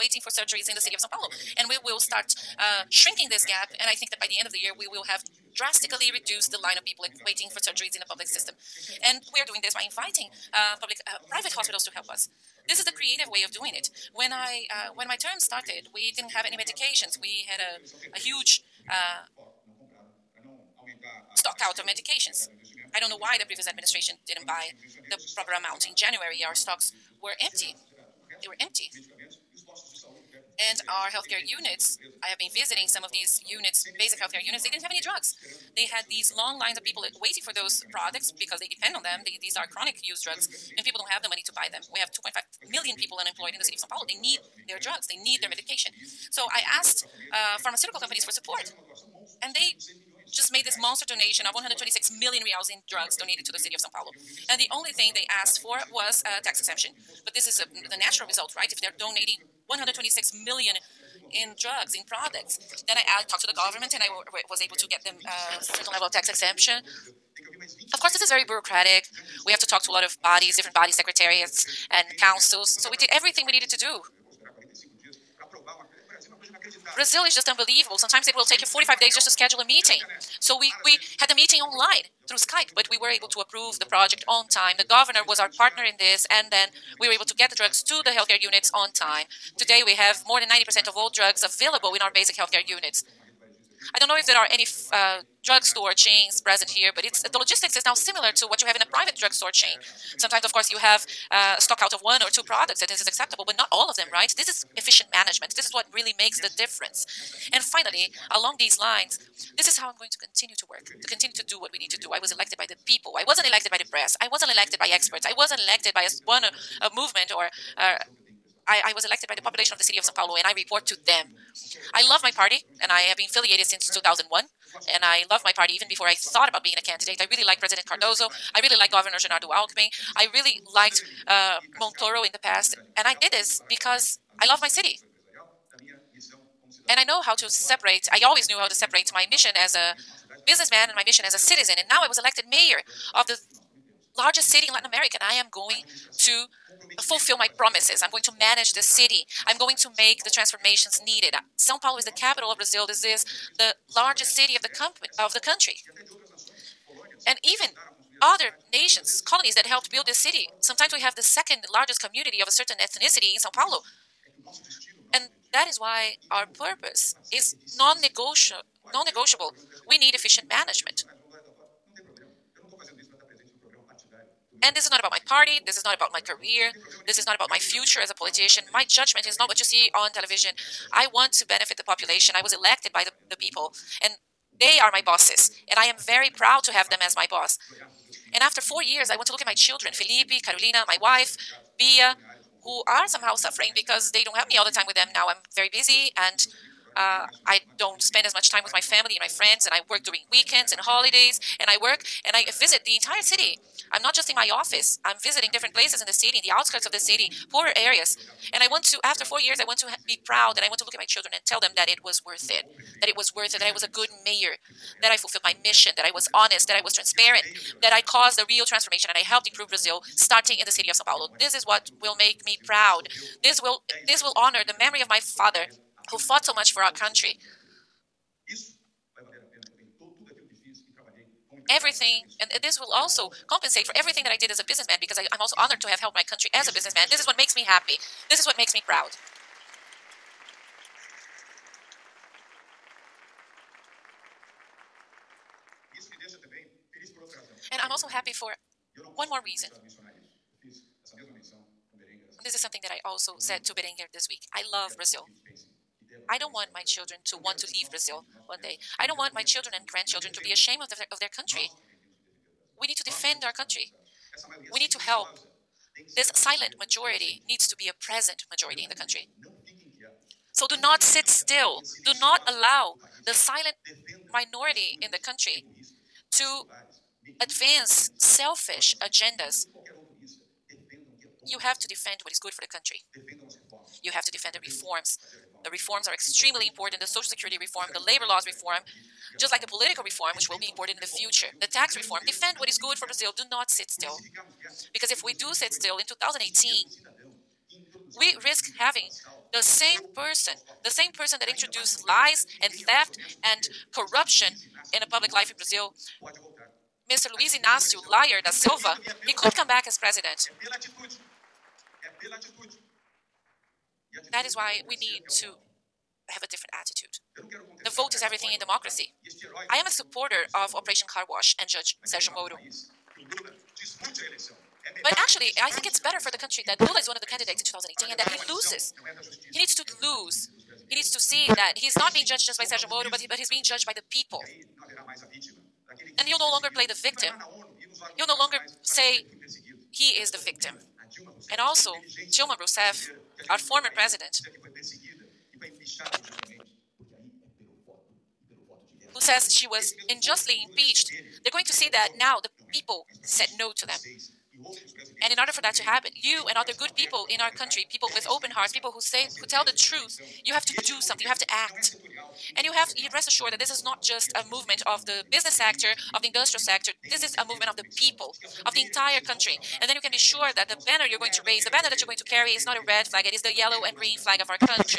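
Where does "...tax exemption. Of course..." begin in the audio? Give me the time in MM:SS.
01:06.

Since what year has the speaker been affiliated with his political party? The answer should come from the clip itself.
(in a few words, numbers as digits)
2001.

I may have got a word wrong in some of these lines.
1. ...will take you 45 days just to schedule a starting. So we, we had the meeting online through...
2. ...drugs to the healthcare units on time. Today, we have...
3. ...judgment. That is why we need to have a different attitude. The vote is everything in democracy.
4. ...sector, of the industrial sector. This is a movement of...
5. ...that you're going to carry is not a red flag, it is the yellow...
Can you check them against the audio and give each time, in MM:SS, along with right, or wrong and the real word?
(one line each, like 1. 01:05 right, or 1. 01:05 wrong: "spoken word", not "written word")
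1. 01:18 wrong: "meeting", not "starting"
2. 01:27 right
3. 05:09 wrong: "president", not "judgment"
4. 06:05 right
5. 06:11 right.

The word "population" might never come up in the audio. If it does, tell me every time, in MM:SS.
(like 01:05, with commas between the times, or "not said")
01:59, 03:01.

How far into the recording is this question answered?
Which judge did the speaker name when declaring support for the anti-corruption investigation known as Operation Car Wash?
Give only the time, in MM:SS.
05:21.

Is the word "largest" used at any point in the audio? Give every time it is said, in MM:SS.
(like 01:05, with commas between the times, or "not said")
02:24, 02:33, 02:41.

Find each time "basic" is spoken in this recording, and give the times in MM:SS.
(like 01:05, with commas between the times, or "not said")
00:33, 01:32.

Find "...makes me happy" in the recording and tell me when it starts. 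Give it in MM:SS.
03:57.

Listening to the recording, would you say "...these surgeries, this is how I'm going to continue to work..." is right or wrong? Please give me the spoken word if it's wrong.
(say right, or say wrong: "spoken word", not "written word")
wrong: "lines", not "surgeries".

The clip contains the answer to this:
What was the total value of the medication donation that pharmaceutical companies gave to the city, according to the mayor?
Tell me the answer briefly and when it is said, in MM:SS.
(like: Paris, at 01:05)
126 million reals, at 00:51.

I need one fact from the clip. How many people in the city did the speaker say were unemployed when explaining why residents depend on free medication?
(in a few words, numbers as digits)
2.5 million.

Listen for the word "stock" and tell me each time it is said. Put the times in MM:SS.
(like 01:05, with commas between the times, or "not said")
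00:21, 00:26, 01:41.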